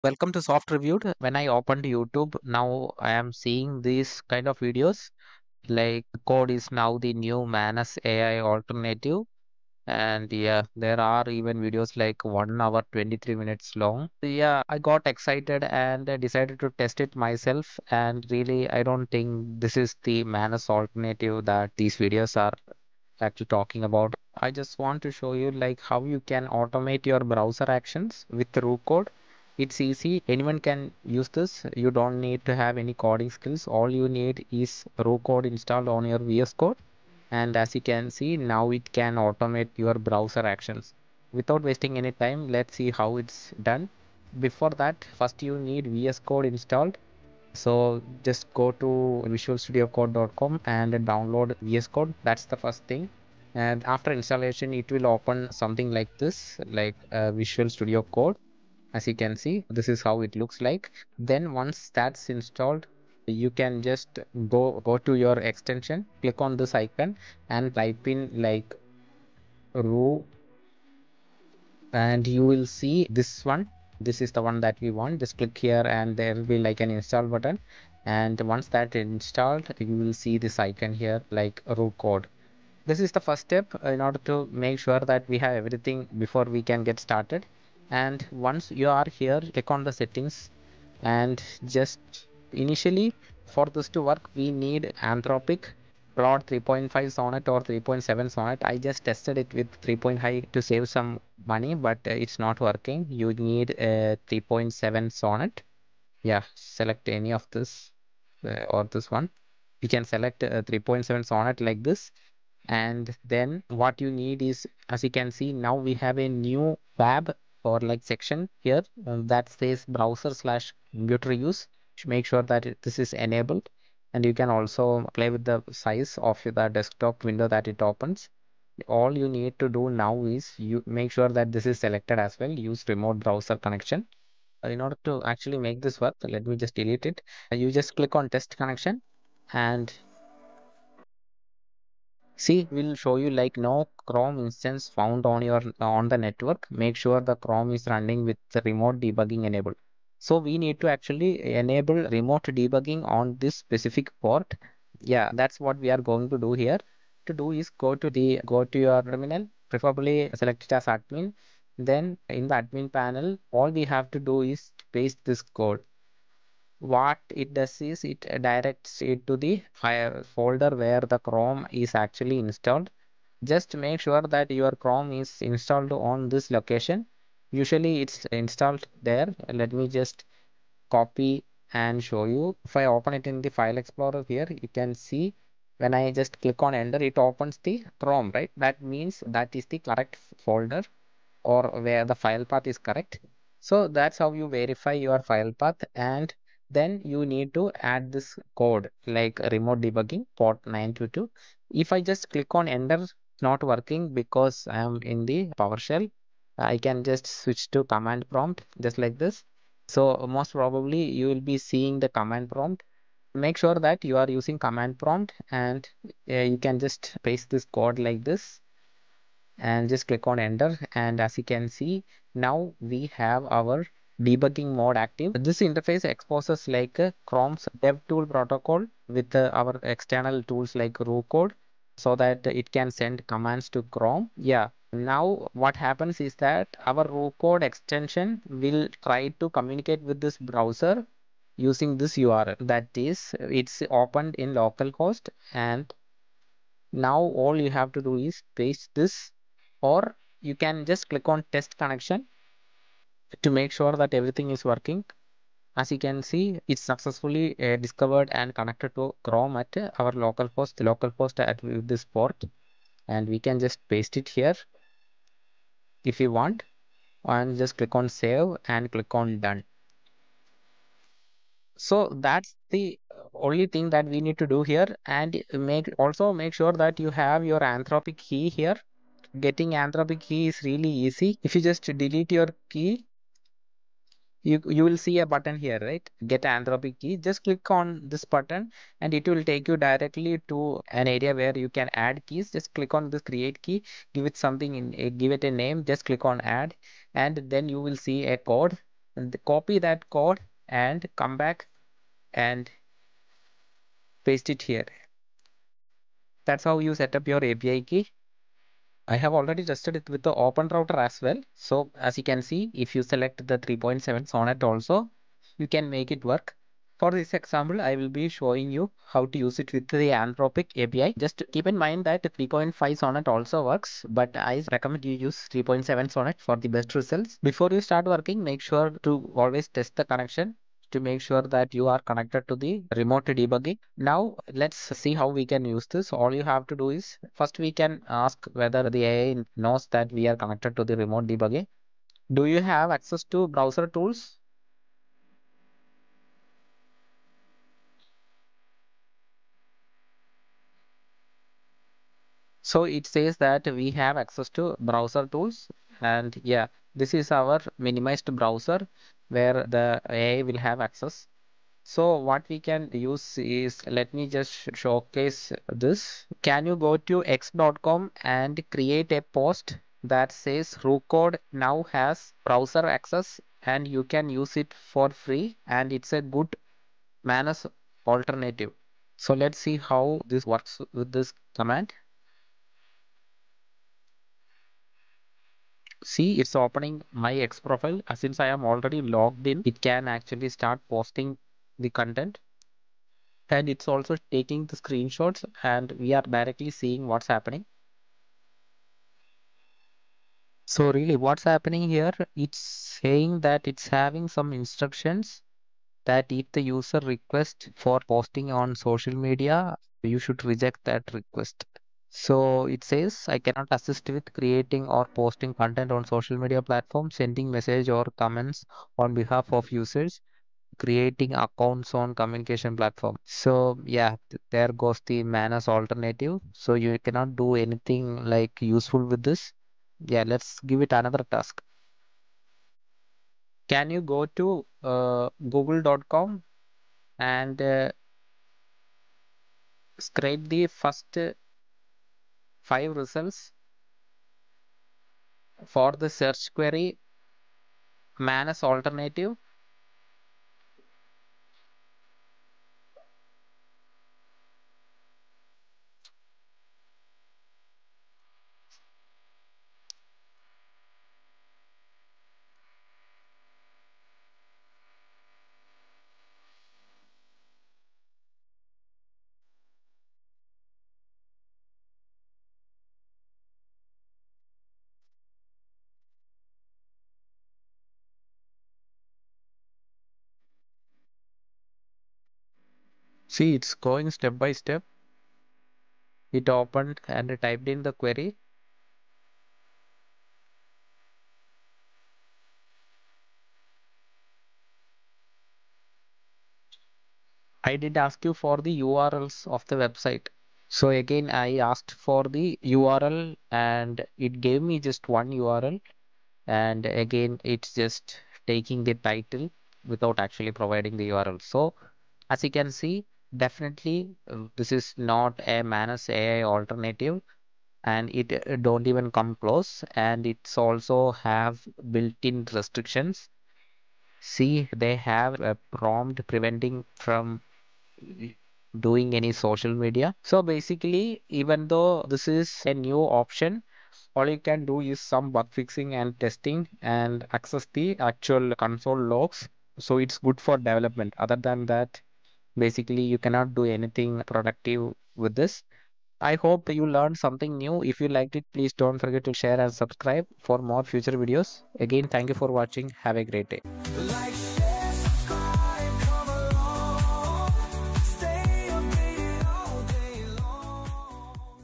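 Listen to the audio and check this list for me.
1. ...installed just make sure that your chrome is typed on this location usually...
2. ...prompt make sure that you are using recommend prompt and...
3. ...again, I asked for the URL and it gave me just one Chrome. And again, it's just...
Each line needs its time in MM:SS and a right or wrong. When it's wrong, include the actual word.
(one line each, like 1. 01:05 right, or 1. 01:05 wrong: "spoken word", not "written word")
1. 02:52 wrong: "installed", not "typed"
2. 03:32 wrong: "command", not "recommend"
3. 08:20 wrong: "URL", not "Chrome".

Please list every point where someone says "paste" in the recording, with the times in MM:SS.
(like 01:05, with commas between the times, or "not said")
02:44, 03:37, 04:08, 04:23, 05:04.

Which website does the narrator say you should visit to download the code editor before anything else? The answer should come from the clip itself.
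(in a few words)
visualstudiocode.com.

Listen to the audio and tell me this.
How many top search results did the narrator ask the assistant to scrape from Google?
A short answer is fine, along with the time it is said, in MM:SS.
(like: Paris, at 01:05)
5, at 07:22.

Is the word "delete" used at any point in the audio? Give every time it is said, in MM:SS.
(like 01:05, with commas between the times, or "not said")
02:16, 04:41.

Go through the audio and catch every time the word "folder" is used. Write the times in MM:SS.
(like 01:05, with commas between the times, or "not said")
02:50, 03:10.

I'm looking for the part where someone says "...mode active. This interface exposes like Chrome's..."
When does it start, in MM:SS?
03:44.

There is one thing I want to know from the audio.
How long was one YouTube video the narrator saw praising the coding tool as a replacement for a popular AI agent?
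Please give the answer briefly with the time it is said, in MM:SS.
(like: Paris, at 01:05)
1 hour 23 minutes, at 00:12.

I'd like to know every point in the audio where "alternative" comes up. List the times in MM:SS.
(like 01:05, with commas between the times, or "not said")
00:08, 00:20, 06:18, 07:05, 07:28, 08:36.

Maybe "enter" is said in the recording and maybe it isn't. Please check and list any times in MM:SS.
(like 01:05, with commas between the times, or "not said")
03:06, 03:22, 03:40.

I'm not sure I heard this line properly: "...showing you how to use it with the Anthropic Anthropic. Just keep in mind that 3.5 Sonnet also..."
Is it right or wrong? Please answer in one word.
wrong.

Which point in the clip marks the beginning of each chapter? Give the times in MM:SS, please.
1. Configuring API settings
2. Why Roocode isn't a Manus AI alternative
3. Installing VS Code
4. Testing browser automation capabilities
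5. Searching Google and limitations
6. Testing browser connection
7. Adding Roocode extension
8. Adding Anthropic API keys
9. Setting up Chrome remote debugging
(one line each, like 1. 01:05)
1. 01:35
2. 08:40
3. 00:23
4. 06:10
5. 07:25
6. 05:30
7. 01:10
8. 04:35
9. 02:40.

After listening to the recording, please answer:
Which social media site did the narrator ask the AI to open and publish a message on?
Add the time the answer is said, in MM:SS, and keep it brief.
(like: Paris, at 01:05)
x.com, at 06:07.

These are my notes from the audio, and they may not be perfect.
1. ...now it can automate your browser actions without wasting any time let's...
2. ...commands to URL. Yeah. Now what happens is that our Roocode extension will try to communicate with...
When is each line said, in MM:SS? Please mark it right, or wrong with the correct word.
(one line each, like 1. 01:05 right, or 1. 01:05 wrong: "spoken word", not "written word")
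1. 00:38 right
2. 03:53 wrong: "Chrome", not "URL".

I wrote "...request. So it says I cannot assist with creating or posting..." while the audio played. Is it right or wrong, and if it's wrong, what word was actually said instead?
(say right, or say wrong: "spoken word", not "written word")
right.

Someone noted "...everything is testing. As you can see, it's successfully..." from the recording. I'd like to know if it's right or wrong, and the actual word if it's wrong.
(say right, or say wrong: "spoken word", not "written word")
wrong: "working", not "testing".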